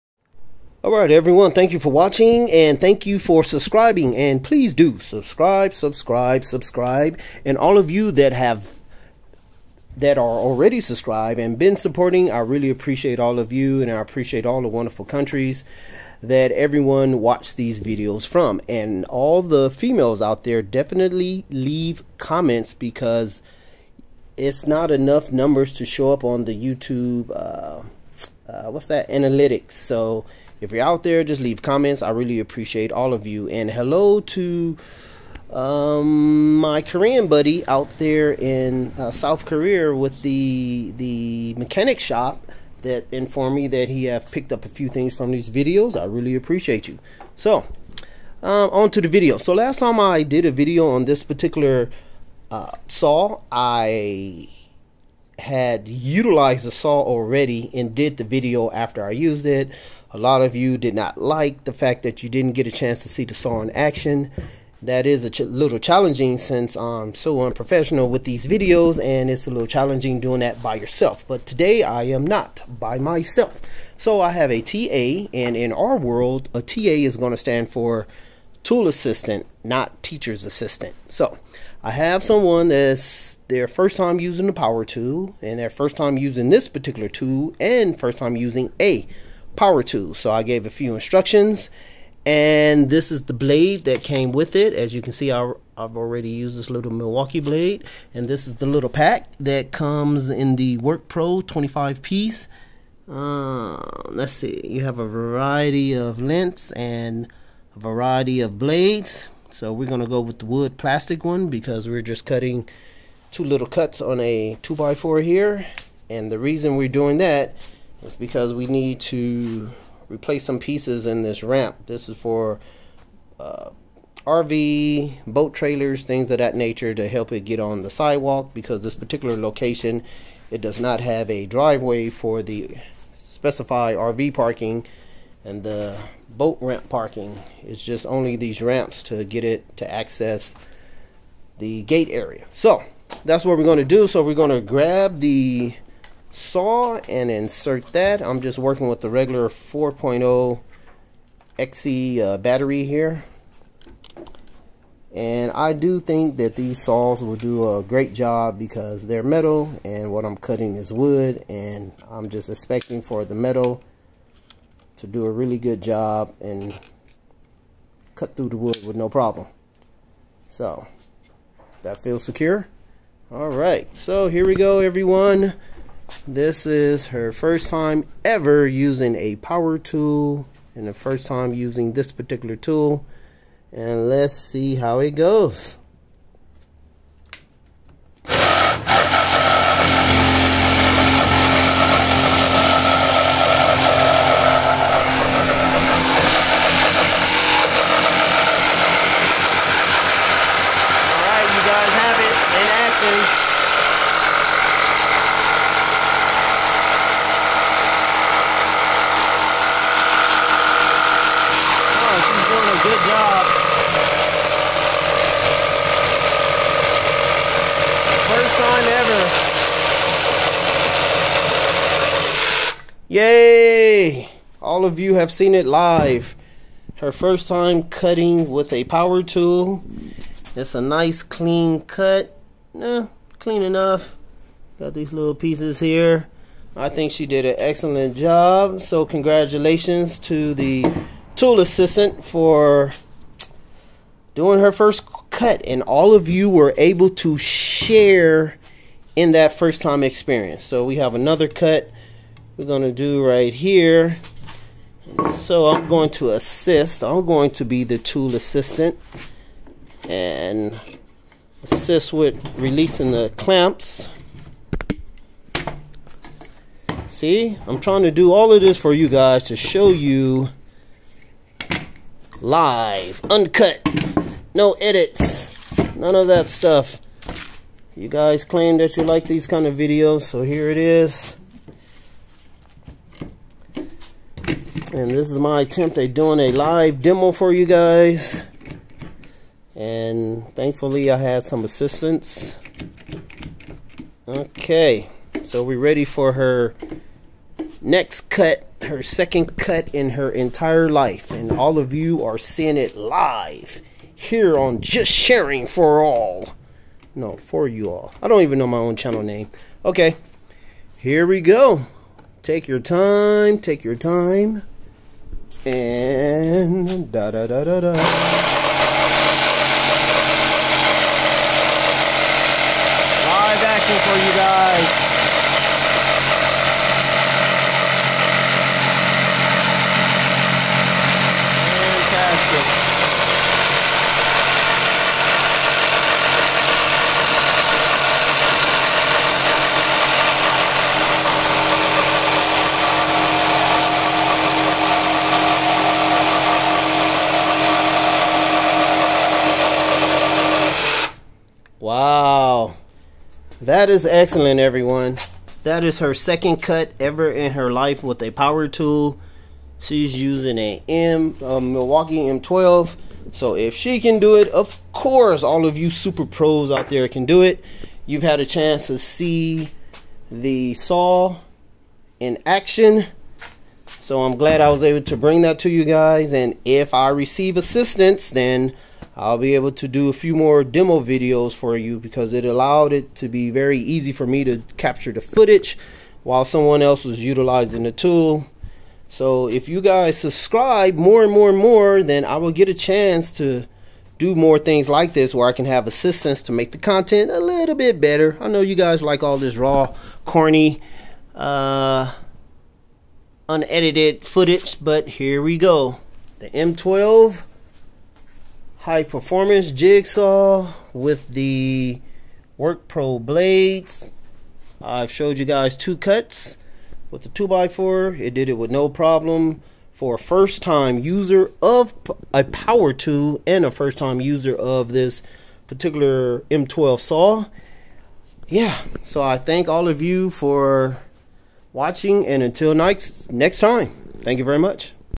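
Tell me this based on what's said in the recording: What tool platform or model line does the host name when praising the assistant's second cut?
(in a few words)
Milwaukee M12.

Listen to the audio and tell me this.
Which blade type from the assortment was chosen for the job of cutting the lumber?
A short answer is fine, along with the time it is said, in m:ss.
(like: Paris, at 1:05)
wood plastic, at 1:50.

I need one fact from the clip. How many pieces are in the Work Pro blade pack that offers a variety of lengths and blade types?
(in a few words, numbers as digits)
25.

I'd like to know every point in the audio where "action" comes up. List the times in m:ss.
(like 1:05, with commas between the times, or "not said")
1:03, 5:23, 6:12.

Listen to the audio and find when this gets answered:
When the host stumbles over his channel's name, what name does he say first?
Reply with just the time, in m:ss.
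5:04.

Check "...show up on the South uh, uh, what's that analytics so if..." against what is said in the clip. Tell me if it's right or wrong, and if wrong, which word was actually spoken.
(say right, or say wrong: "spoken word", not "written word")
wrong: "YouTube", not "South".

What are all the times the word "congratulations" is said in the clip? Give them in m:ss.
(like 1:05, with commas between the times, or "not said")
3:59.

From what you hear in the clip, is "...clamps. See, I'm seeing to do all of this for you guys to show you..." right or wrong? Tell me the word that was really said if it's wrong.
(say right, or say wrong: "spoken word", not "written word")
wrong: "trying", not "seeing".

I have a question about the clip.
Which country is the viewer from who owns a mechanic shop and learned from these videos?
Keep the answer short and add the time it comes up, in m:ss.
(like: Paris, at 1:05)
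South Korea, at 0:39.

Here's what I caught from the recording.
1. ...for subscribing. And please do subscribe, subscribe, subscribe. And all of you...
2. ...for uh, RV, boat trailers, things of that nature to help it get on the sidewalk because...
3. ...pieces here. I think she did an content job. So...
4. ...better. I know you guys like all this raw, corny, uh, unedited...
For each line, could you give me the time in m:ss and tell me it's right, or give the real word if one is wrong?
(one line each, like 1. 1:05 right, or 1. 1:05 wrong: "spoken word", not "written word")
1. 0:03 right
2. 2:02 right
3. 3:55 wrong: "excellent", not "content"
4. 6:37 right.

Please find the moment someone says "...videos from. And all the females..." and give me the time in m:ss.
0:17.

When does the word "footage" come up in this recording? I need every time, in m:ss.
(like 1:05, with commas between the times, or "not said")
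6:25, 6:44.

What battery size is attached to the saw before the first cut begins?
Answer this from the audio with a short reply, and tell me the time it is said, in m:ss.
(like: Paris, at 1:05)
4.0 XC, at 2:29.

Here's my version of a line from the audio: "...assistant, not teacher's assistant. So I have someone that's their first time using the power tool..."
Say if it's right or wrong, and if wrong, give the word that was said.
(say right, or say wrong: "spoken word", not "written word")
right.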